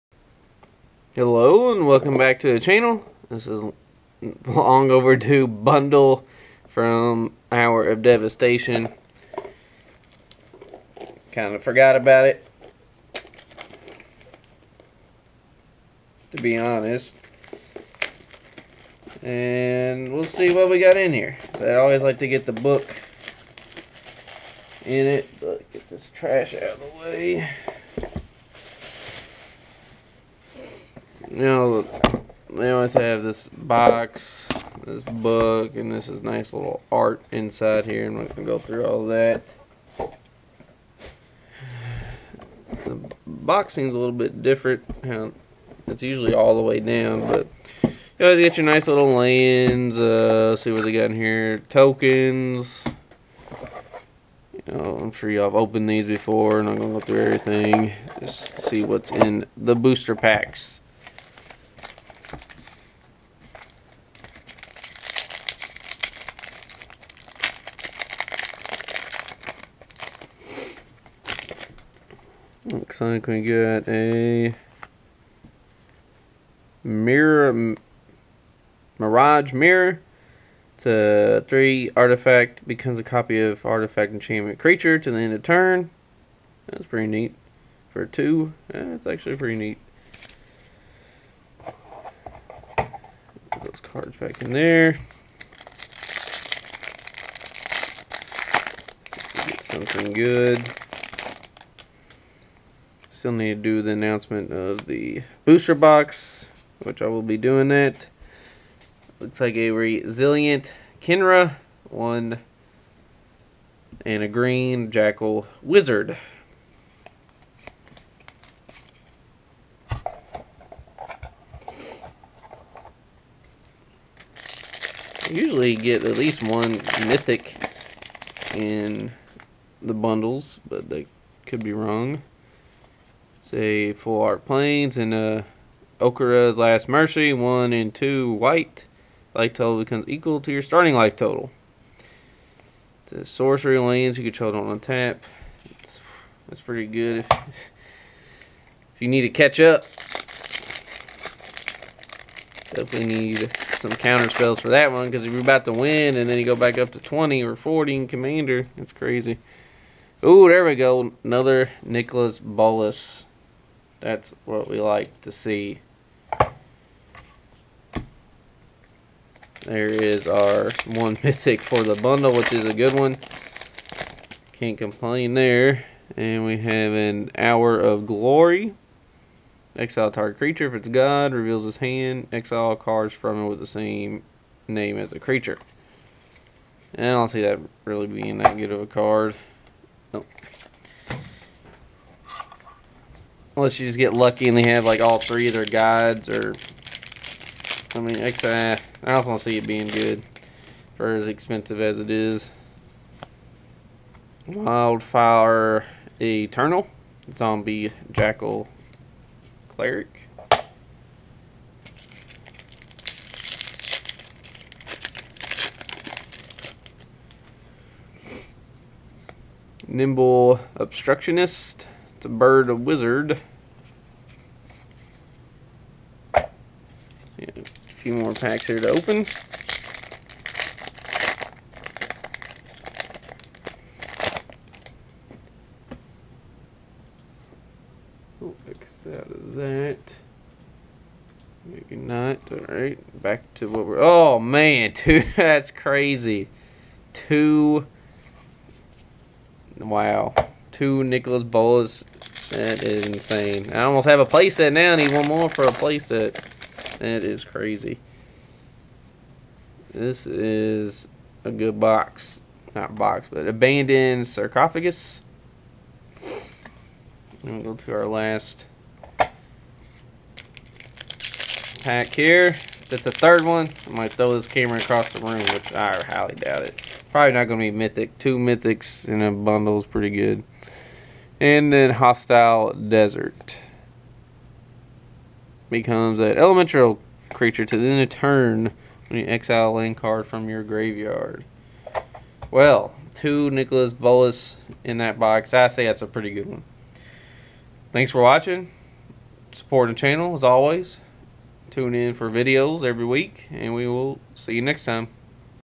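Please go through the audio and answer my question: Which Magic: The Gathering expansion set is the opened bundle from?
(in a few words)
Hour of Devastation.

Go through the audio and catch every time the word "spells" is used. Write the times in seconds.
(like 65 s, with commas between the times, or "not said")
154 s.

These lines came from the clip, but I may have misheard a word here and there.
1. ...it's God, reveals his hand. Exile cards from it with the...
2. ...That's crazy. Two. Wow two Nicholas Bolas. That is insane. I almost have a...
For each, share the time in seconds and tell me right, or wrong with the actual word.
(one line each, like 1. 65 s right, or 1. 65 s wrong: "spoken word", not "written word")
1. 180 s right
2. 245 s right.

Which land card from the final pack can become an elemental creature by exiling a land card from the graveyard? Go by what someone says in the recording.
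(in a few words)
Hostile Desert.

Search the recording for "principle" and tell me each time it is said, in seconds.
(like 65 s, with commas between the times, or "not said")
not said.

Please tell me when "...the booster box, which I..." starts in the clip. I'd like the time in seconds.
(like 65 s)
104 s.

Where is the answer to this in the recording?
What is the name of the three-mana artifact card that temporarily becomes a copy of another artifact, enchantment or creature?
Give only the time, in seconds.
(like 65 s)
78 s.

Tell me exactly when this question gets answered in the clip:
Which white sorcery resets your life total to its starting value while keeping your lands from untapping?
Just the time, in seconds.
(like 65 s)
135 s.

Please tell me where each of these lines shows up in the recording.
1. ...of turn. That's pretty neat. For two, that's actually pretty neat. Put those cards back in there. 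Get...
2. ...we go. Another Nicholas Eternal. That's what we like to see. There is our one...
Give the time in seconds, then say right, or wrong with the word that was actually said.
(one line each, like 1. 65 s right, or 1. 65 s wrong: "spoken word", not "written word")
1. 85 s right
2. 160 s wrong: "Bolas", not "Eternal".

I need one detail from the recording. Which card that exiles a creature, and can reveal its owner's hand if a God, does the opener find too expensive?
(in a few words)
Hour of Glory.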